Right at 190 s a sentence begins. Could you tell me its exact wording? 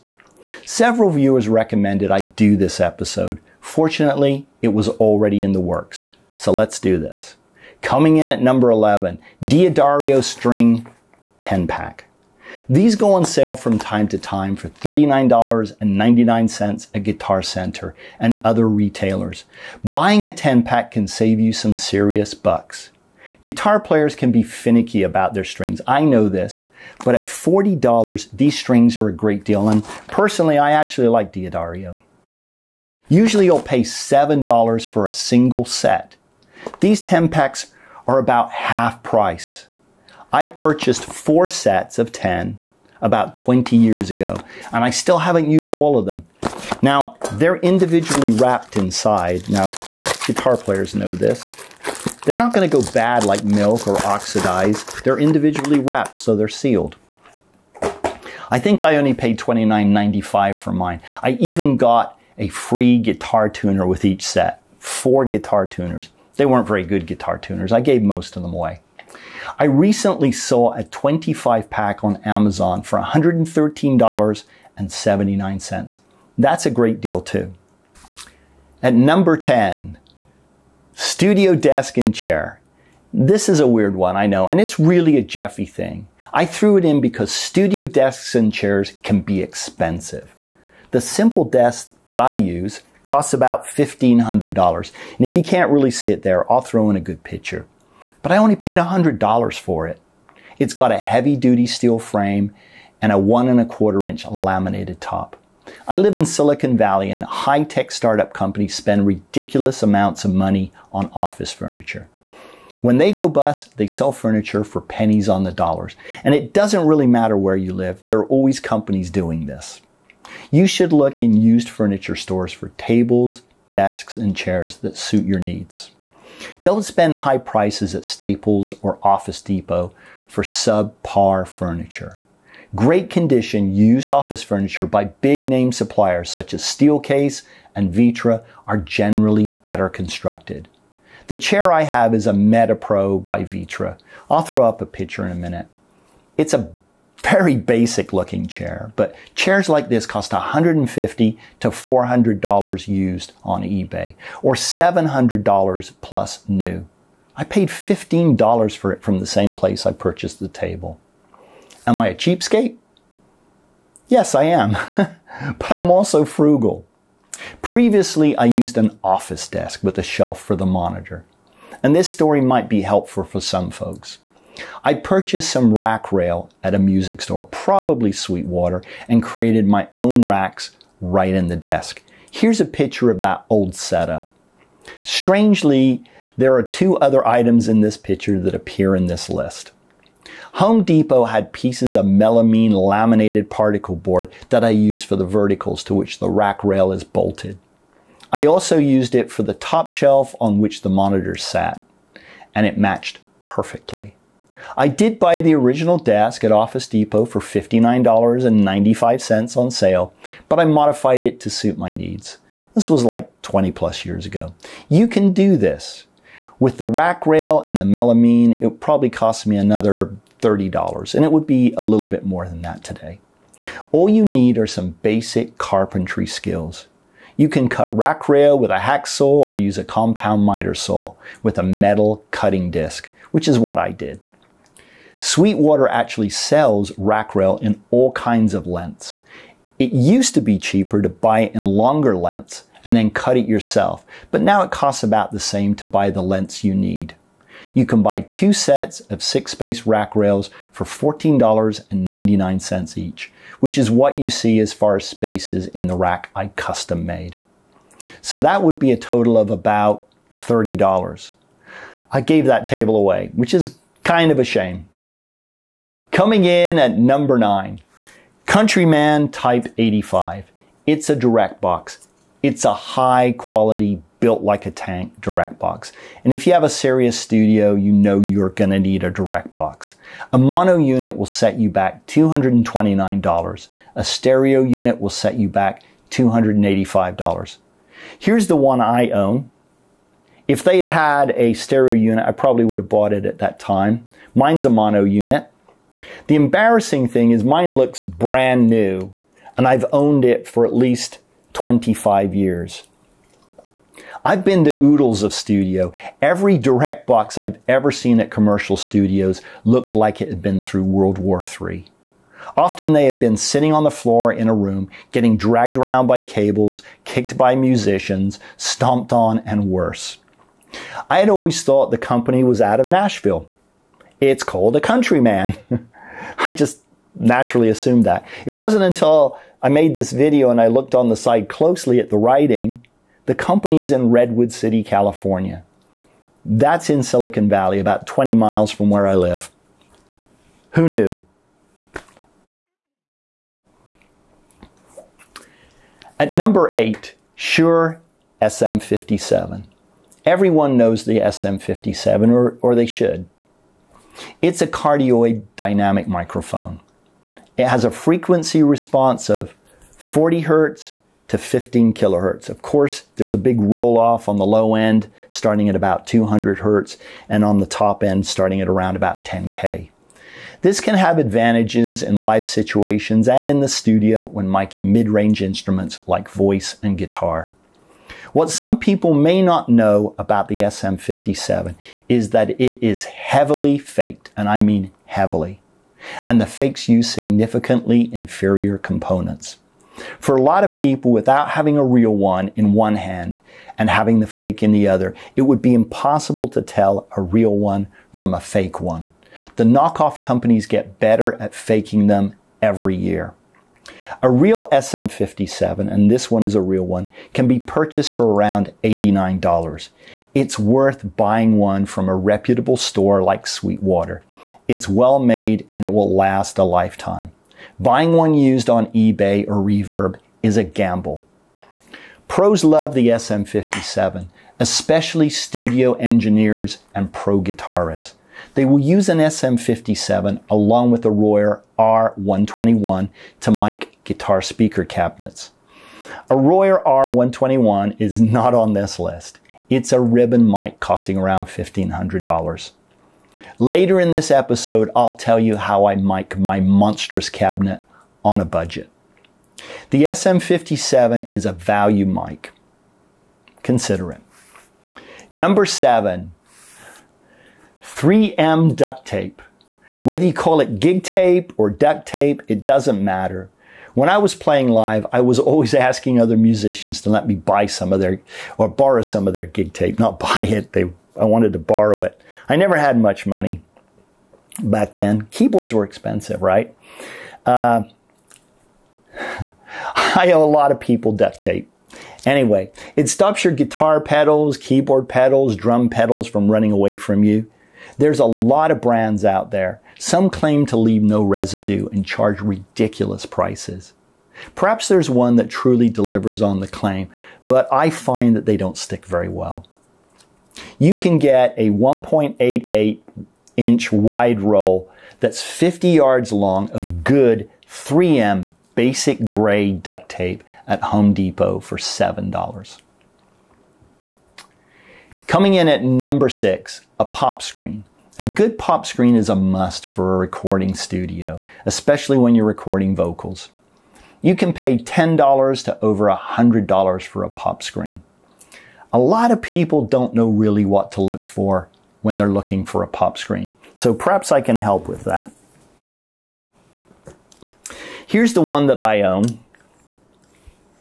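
Home Depot had pieces of melamine laminated particle board that I used for the verticals to which the rack rail is bolted.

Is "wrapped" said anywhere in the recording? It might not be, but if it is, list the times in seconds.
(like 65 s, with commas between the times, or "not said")
48 s, 55 s.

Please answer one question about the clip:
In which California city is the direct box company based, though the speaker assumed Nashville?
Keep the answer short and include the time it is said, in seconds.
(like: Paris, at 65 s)
Redwood City, at 334 s.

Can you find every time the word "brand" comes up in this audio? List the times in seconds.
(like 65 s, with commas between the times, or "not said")
298 s, 488 s.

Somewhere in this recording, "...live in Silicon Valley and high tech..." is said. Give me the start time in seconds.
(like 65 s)
105 s.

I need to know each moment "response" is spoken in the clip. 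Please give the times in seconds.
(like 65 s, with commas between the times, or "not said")
358 s.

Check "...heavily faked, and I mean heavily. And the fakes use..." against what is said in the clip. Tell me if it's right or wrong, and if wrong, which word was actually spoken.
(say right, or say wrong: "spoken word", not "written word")
right.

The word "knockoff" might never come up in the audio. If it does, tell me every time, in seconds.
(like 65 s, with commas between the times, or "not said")
399 s.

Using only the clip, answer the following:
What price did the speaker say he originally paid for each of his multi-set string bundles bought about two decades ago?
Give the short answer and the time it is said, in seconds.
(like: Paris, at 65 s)
$29.95, at 59 s.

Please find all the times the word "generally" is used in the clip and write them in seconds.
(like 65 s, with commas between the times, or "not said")
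138 s.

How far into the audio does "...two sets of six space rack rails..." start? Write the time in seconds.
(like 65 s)
248 s.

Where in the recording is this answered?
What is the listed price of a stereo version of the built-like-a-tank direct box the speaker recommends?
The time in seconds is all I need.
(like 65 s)
286 s.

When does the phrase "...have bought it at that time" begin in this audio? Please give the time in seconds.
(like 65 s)
292 s.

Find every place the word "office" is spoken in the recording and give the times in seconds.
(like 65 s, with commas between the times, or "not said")
111 s, 129 s, 134 s, 169 s, 206 s.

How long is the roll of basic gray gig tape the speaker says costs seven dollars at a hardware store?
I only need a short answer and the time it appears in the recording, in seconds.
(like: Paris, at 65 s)
50 yards, at 505 s.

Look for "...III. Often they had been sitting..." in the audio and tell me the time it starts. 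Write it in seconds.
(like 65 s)
311 s.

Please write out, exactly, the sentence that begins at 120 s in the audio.
You should look in used furniture stores for tables, desks, and chairs that suit your needs.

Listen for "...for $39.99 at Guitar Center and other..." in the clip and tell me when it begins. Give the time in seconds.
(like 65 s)
14 s.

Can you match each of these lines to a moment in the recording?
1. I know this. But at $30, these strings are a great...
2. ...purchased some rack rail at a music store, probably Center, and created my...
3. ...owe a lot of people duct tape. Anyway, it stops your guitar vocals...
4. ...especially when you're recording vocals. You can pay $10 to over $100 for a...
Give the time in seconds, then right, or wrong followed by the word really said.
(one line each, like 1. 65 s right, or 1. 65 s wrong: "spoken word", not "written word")
1. 25 s wrong: "40", not "30"
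2. 174 s wrong: "Sweetwater", not "Center"
3. 480 s wrong: "pedals", not "vocals"
4. 521 s right.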